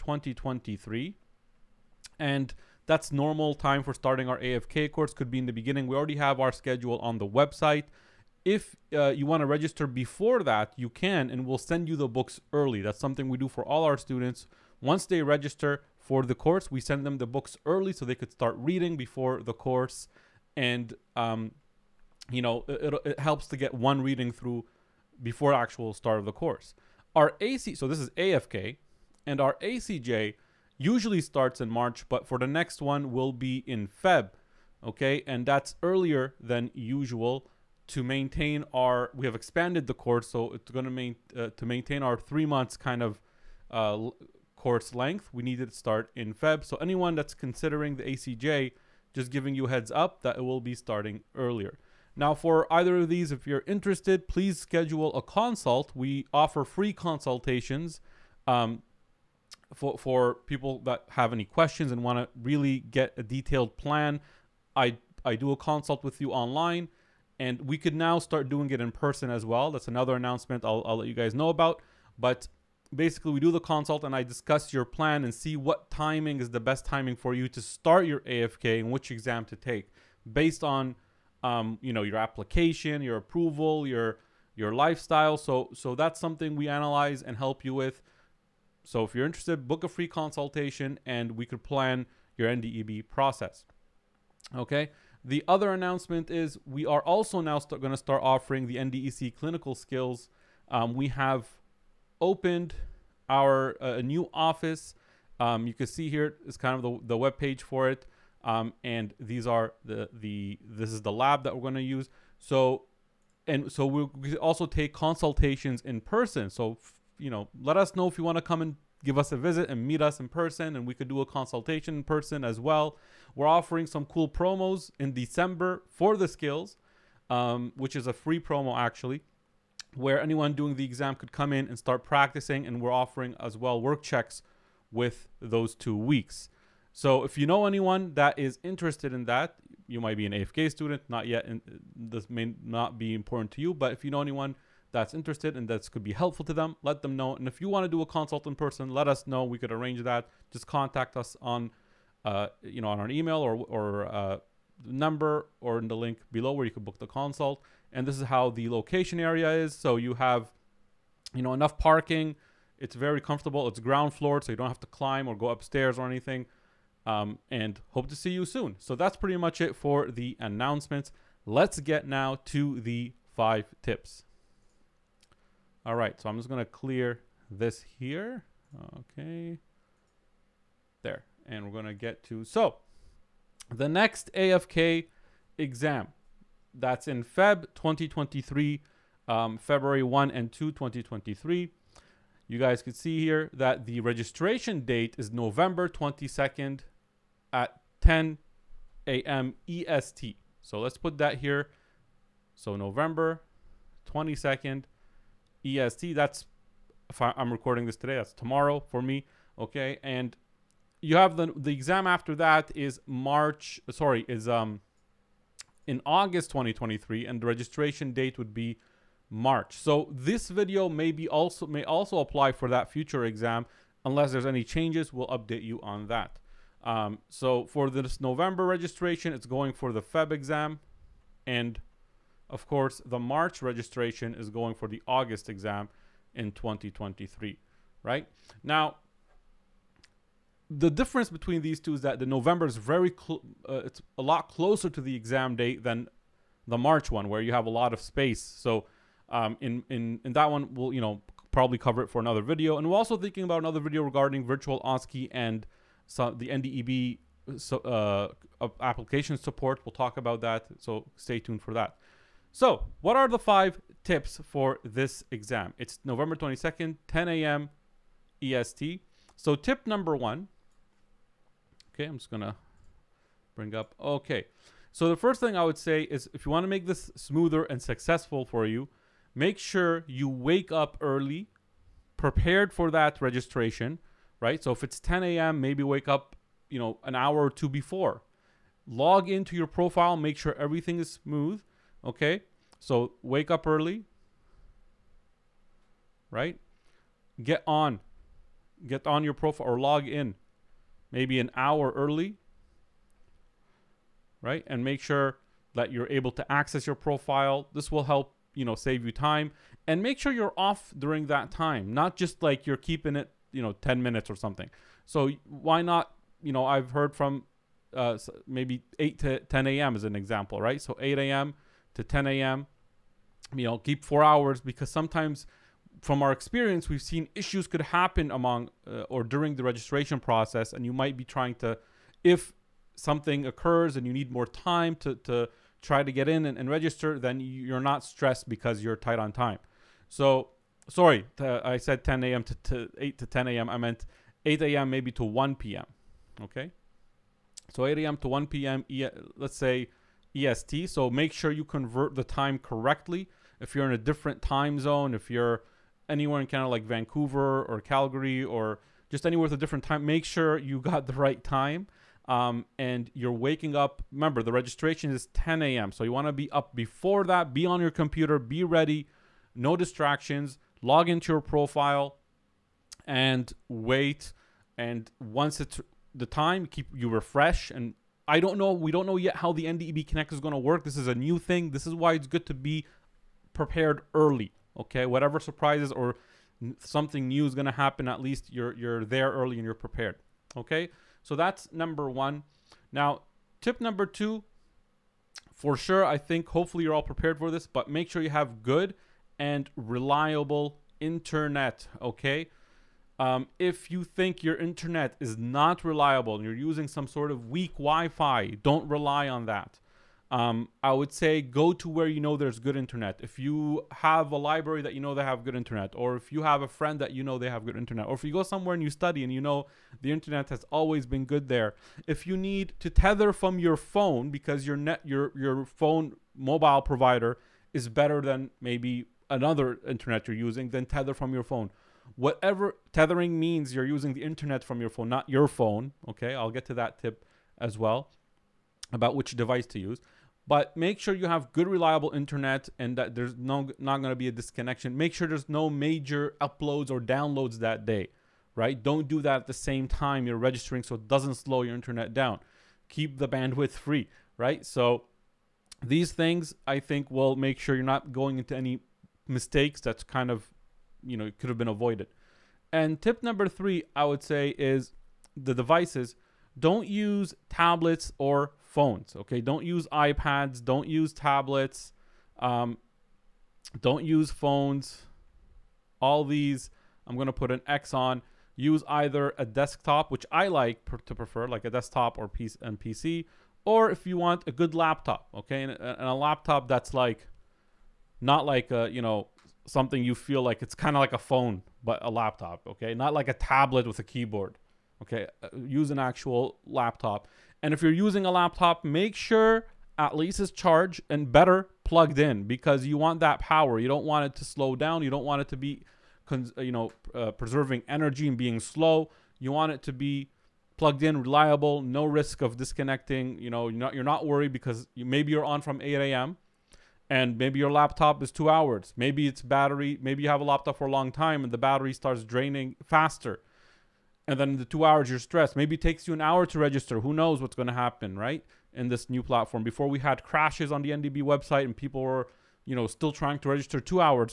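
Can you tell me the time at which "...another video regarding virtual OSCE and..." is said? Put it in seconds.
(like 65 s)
253 s.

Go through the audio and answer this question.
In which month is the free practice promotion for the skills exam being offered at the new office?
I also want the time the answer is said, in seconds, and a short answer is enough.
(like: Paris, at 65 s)
December, at 125 s.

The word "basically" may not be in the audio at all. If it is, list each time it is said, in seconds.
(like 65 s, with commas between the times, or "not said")
72 s.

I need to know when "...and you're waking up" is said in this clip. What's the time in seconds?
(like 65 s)
362 s.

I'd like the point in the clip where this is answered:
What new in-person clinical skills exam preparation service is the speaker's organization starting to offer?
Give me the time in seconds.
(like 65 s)
98 s.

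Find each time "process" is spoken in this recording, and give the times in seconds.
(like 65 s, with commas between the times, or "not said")
93 s, 330 s.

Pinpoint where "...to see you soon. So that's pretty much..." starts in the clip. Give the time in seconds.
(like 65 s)
168 s.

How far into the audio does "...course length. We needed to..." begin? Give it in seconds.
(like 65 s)
44 s.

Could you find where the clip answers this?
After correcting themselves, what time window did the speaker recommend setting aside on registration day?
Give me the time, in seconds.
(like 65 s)
347 s.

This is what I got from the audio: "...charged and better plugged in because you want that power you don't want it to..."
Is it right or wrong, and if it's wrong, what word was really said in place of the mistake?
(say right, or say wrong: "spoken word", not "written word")
right.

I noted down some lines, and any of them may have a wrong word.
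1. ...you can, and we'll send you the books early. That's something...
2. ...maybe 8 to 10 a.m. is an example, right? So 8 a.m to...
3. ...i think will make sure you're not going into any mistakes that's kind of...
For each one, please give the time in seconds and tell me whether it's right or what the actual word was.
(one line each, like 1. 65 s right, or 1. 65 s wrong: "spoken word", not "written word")
1. 10 s right
2. 318 s right
3. 456 s right.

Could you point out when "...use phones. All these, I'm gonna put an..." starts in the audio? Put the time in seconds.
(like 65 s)
474 s.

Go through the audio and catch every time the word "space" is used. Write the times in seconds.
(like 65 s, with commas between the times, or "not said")
248 s.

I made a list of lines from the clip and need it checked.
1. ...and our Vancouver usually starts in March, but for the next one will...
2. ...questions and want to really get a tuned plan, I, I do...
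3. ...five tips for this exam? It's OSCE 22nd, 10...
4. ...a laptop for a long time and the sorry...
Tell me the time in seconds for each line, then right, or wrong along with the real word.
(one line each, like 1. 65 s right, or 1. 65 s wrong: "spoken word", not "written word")
1. 29 s wrong: "ACJ", not "Vancouver"
2. 61 s wrong: "detailed", not "tuned"
3. 263 s wrong: "November", not "OSCE"
4. 520 s wrong: "battery", not "sorry".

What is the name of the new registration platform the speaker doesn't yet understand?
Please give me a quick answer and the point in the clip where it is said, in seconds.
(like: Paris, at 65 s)
NDEB Connect, at 379 s.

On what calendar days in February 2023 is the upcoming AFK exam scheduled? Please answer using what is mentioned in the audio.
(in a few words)
February 1 and 2.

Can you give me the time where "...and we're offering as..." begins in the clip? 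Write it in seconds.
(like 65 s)
132 s.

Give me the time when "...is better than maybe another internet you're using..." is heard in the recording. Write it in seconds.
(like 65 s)
427 s.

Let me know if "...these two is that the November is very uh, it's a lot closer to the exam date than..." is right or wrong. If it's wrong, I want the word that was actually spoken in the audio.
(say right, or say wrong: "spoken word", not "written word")
right.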